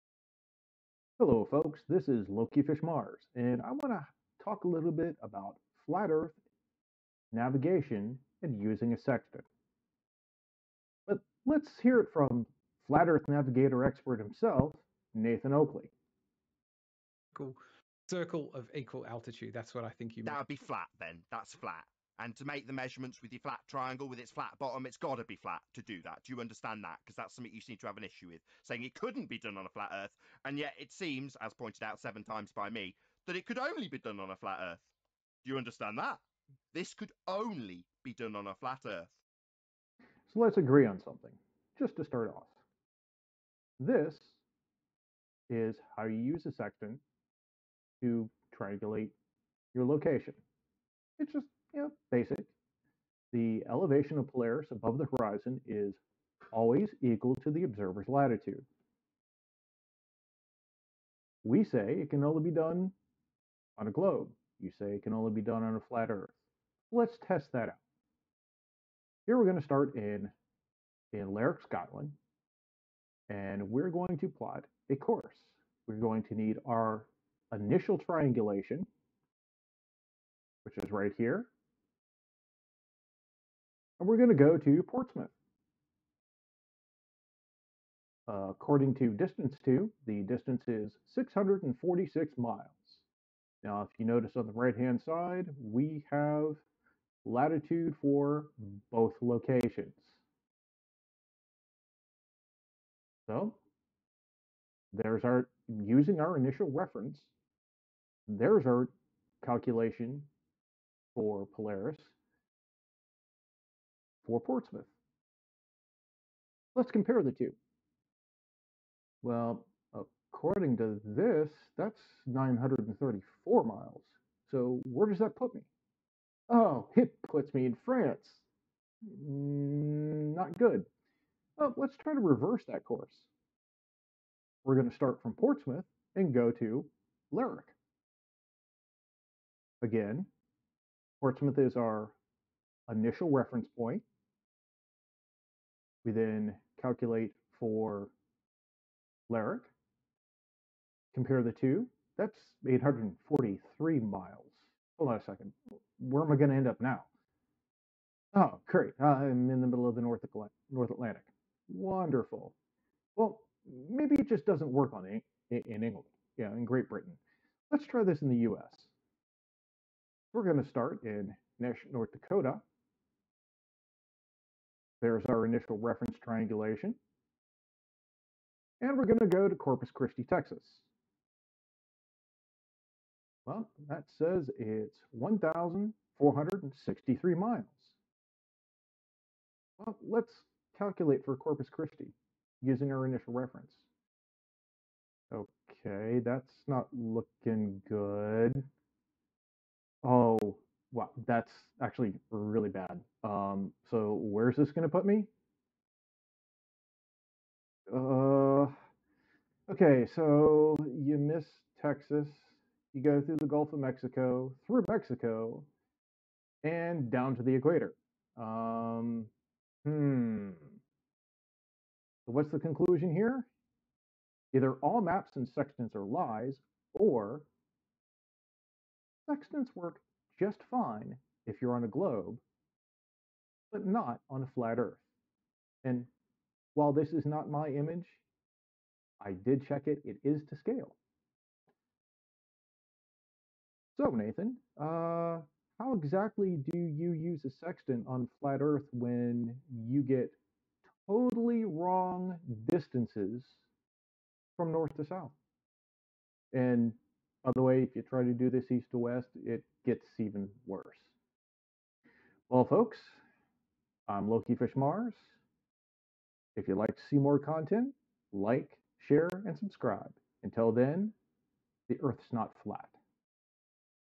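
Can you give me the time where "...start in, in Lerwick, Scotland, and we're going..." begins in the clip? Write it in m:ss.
1:09.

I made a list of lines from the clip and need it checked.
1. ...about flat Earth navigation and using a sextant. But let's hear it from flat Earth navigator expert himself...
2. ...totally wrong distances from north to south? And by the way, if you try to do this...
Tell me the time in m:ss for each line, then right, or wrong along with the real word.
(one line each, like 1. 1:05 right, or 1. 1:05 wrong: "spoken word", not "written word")
1. 0:05 right
2. 4:11 right.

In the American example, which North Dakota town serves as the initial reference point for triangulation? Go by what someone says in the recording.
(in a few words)
Nash.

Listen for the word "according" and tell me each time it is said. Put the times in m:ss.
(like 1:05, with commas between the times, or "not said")
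1:28, 1:59.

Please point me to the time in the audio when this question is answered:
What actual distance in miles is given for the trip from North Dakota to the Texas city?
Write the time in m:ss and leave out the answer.
3:05.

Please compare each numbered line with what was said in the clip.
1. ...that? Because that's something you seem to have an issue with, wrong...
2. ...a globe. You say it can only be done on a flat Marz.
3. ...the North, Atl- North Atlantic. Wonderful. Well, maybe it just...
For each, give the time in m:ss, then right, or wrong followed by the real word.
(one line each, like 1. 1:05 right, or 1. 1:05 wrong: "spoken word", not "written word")
1. 0:26 wrong: "saying", not "wrong"
2. 1:03 wrong: "Earth", not "Marz"
3. 2:39 right.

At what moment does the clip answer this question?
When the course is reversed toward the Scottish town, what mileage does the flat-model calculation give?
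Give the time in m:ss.
2:32.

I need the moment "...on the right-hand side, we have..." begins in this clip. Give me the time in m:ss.
1:34.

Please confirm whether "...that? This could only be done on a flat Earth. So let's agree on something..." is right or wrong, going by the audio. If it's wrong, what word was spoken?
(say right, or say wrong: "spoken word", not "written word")
right.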